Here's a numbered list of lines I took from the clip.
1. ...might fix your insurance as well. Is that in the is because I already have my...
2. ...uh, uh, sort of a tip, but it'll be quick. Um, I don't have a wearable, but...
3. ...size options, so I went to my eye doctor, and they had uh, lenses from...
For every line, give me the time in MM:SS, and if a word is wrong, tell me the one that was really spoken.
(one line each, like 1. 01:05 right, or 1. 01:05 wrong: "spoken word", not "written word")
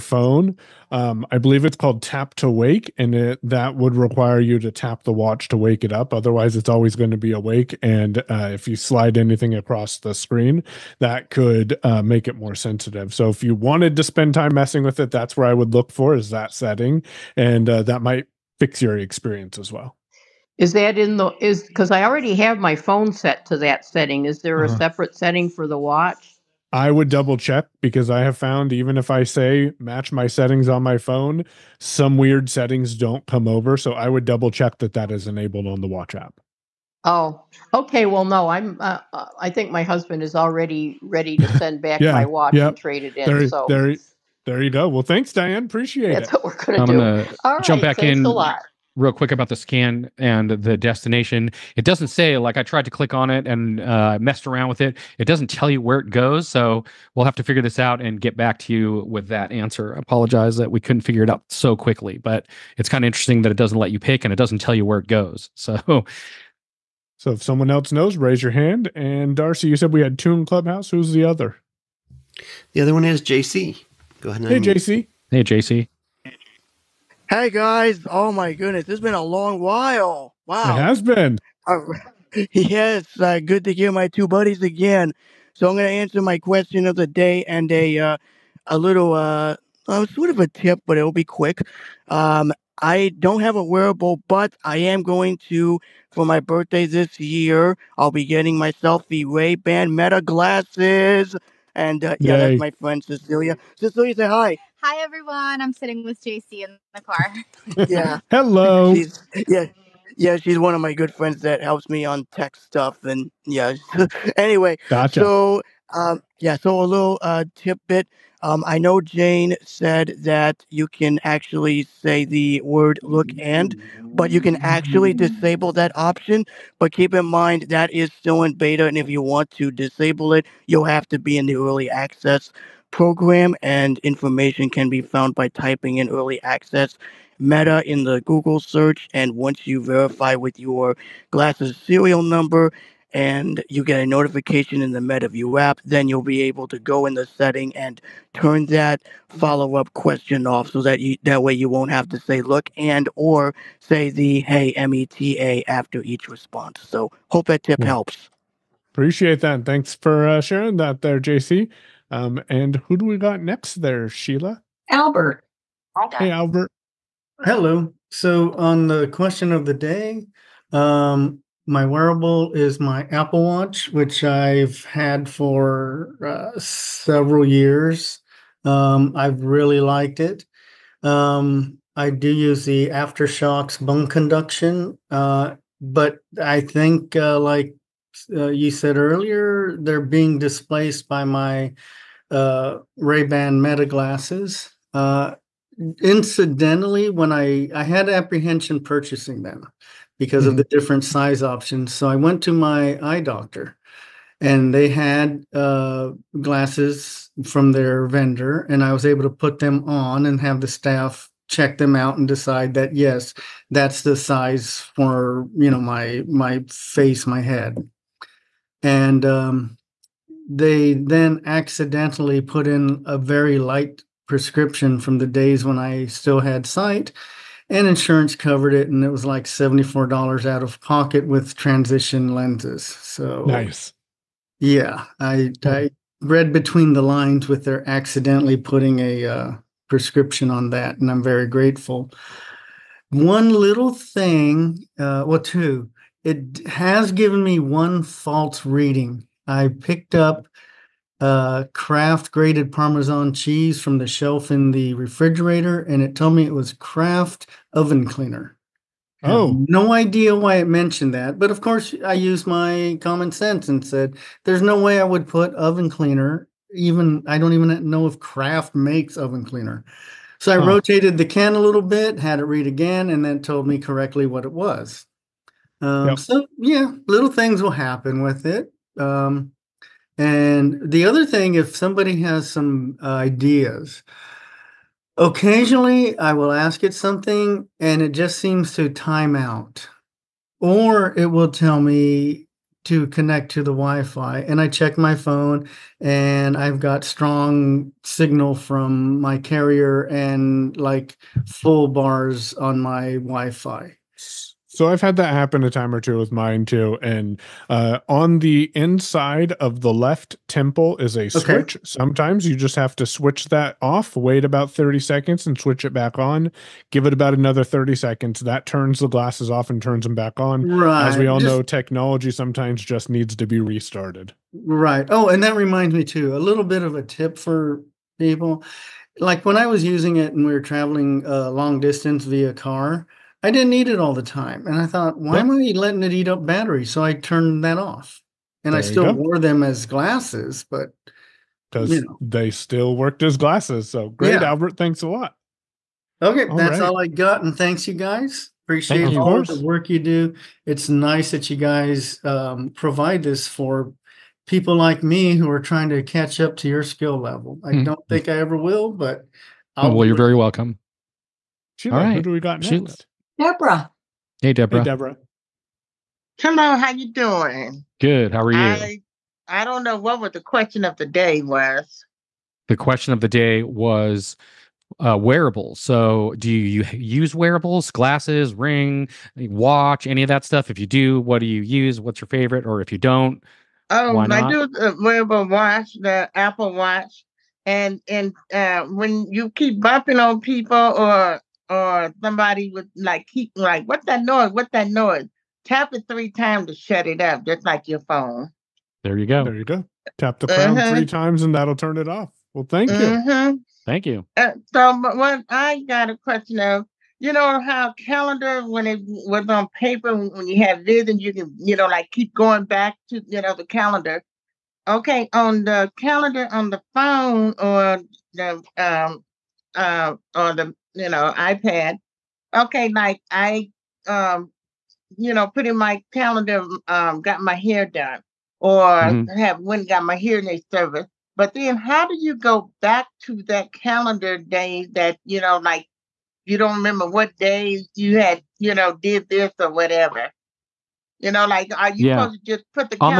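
1. 00:18 wrong: "experience", not "insurance"
2. 01:29 right
3. 03:21 wrong: "glasses", not "lenses".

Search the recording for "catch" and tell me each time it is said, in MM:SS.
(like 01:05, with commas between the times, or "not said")
05:56.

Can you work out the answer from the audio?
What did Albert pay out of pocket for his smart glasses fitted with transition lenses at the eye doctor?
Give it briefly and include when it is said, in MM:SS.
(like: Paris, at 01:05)
$74, at 03:49.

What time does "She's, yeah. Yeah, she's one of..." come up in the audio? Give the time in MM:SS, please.
01:48.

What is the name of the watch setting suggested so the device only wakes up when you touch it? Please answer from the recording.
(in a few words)
tap to wake.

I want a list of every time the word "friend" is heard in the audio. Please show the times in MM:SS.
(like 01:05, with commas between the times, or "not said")
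01:42, 01:51.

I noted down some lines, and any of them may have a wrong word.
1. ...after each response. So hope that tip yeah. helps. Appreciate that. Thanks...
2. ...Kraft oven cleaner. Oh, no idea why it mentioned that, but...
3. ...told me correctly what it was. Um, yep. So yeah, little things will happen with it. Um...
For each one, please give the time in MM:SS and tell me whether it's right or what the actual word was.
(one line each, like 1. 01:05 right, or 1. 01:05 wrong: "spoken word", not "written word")
1. 02:35 right
2. 04:16 right
3. 04:33 right.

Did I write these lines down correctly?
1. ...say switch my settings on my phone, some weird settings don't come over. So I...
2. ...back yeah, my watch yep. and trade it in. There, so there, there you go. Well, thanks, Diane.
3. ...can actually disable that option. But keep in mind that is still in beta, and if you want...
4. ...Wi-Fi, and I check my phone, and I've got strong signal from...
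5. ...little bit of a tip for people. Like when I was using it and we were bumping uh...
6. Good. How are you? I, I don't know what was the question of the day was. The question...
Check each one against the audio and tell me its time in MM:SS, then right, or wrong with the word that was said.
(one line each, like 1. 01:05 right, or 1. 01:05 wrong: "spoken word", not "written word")
1. 00:29 wrong: "match", not "switch"
2. 00:41 right
3. 02:04 right
4. 04:53 right
5. 05:26 wrong: "traveling", not "bumping"
6. 06:07 right.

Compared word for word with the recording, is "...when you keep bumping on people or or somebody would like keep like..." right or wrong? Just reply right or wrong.
right.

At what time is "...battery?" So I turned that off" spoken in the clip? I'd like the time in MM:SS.
05:36.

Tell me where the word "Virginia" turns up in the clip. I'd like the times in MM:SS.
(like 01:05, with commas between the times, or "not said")
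not said.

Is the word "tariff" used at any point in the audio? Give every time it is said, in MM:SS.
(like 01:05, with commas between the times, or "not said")
not said.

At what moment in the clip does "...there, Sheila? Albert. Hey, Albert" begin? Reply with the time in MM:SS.
02:43.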